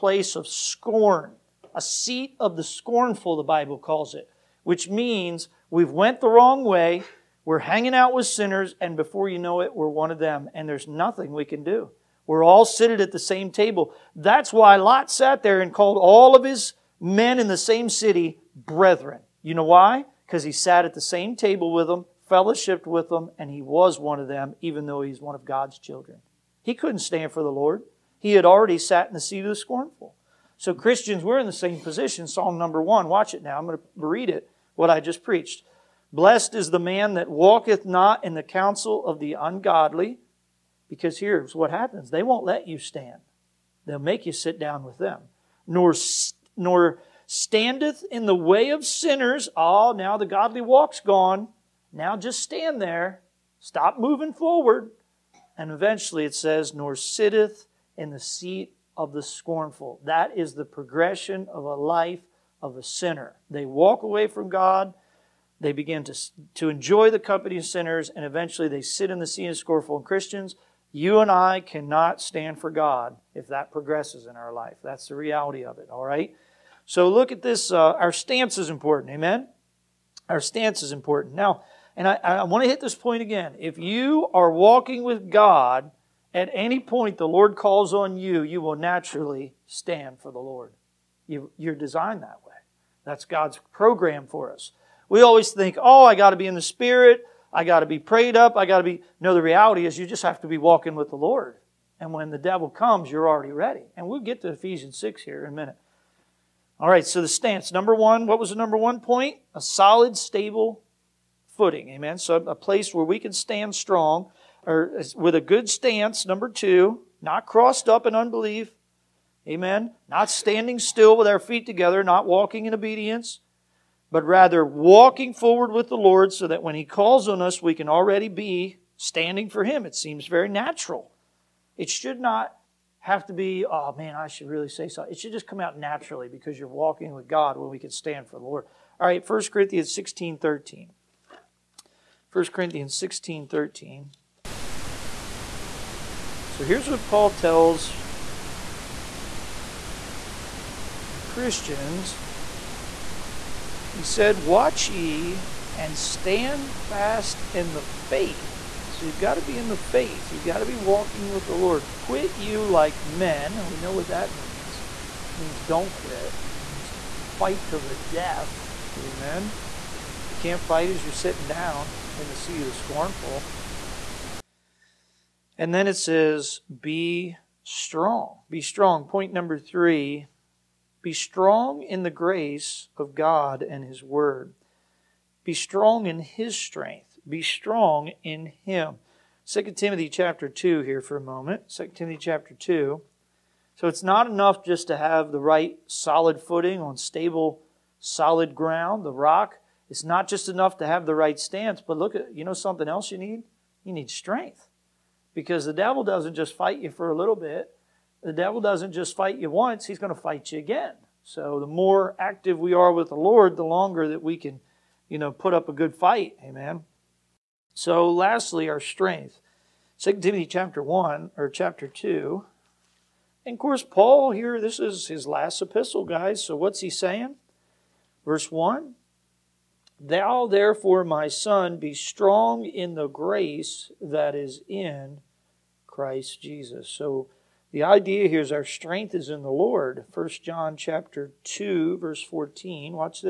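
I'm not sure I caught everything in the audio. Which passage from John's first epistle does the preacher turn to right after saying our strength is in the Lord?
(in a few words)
1 John 2:14.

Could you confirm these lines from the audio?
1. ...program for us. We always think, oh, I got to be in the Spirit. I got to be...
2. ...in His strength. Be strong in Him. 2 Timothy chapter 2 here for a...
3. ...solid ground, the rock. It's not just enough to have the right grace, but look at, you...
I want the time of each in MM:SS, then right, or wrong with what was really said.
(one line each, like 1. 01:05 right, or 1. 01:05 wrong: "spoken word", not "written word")
1. 01:33 right
2. 03:06 right
3. 03:17 wrong: "stance", not "grace".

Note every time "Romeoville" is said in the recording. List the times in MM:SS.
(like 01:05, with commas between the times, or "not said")
not said.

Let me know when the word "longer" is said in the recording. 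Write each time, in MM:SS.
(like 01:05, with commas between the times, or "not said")
03:33.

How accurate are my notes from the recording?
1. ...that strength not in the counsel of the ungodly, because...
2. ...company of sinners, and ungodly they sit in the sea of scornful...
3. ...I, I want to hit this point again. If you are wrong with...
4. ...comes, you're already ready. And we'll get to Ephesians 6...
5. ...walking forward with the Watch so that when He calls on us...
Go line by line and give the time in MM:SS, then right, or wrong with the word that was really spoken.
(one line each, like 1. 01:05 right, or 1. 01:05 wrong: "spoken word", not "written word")
1. 00:37 wrong: "walketh", not "strength"
2. 01:07 wrong: "eventually", not "ungodly"
3. 01:22 wrong: "walking", not "wrong"
4. 01:42 right
5. 02:04 wrong: "Lord", not "Watch".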